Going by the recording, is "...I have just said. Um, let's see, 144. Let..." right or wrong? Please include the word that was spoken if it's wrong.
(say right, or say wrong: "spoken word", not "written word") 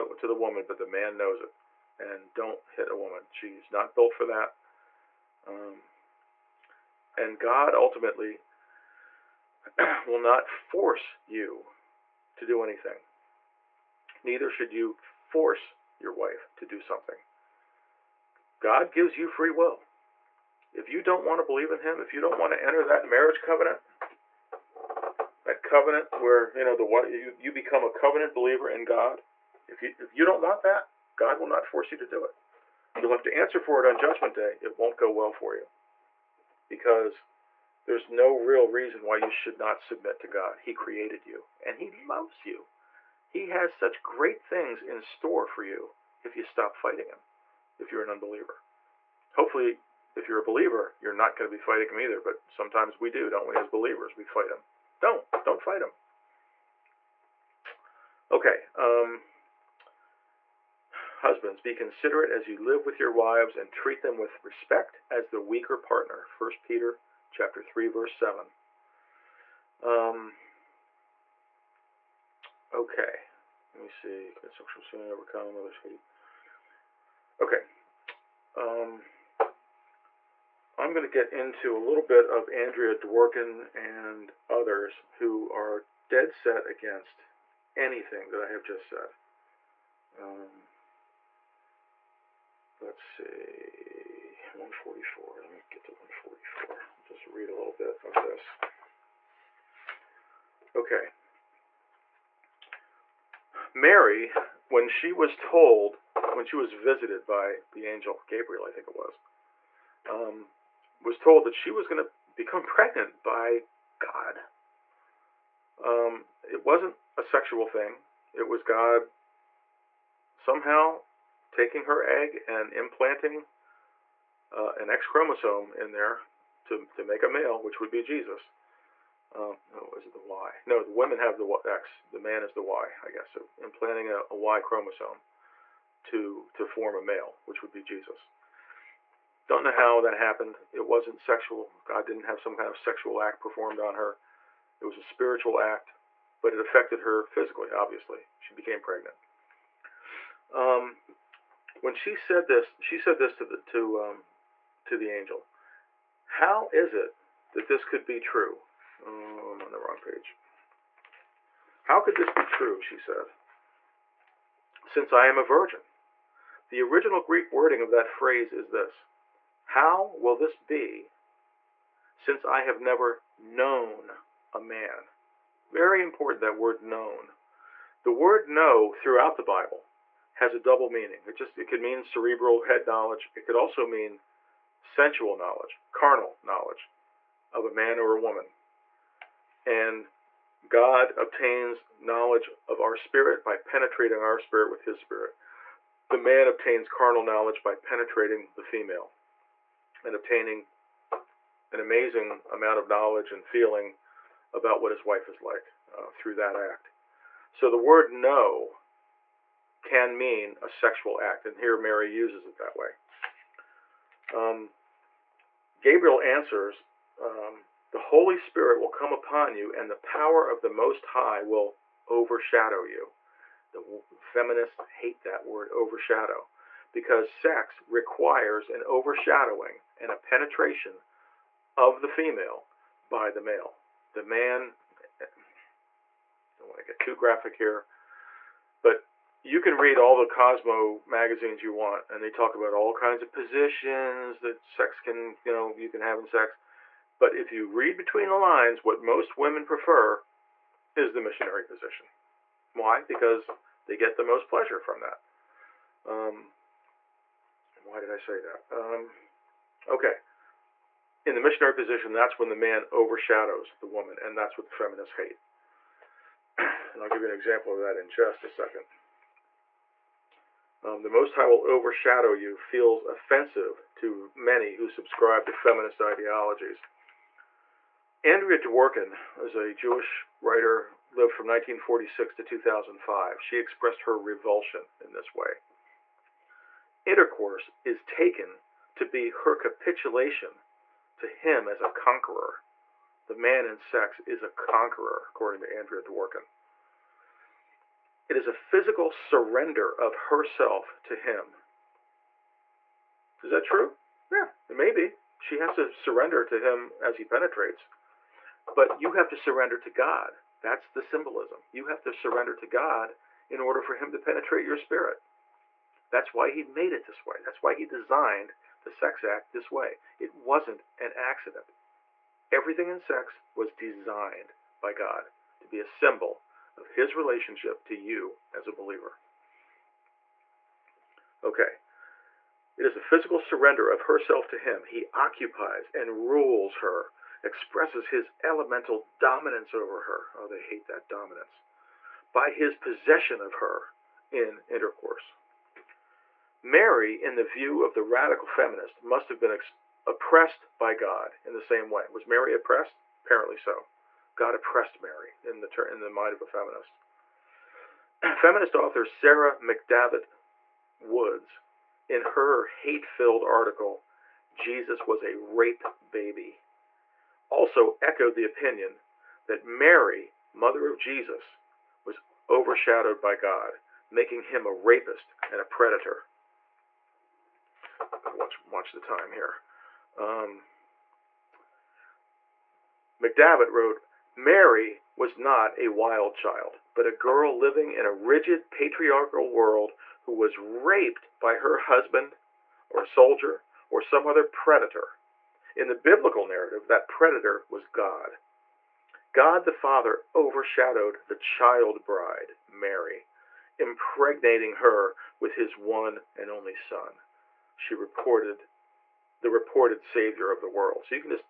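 right.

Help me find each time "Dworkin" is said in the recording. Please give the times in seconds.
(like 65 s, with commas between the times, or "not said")
82 s, 278 s, 296 s.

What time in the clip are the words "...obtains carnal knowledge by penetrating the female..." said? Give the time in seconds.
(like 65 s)
196 s.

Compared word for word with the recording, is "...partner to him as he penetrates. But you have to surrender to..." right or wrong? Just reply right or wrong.
wrong.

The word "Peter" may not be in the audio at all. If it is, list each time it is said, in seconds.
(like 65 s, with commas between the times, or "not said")
66 s.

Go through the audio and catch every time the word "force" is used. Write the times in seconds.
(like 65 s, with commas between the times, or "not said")
10 s, 15 s, 31 s.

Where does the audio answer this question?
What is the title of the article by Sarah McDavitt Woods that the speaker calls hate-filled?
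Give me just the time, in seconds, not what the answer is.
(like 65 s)
364 s.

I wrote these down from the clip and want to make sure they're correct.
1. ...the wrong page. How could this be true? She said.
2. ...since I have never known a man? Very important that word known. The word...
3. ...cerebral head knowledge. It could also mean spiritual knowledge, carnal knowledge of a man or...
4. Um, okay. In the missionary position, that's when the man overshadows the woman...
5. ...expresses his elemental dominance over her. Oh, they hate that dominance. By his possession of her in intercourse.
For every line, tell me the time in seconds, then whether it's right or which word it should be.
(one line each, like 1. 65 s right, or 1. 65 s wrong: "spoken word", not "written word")
1. 159 s right
2. 172 s right
3. 182 s wrong: "sensual", not "spiritual"
4. 258 s right
5. 337 s right.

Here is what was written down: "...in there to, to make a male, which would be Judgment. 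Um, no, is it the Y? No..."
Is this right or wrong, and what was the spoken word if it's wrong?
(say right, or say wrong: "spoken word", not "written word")
wrong: "Jesus", not "Judgment".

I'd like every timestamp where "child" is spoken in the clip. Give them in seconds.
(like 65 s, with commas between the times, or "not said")
386 s, 401 s.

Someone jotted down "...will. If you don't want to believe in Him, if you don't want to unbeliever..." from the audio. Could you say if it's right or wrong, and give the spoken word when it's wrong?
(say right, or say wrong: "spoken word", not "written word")
wrong: "enter", not "unbeliever".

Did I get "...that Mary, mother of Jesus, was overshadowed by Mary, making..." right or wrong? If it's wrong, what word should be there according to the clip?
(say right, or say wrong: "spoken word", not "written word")
wrong: "God", not "Mary".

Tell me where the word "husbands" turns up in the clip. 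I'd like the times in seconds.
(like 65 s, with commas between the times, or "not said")
61 s, 391 s.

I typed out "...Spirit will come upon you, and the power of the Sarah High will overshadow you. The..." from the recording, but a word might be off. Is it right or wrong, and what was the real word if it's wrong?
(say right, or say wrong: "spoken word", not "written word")
wrong: "Most", not "Sarah".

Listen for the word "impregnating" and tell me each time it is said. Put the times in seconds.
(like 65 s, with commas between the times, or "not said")
403 s.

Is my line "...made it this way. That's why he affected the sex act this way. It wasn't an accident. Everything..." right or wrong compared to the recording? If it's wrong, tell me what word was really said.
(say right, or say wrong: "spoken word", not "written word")
wrong: "designed", not "affected".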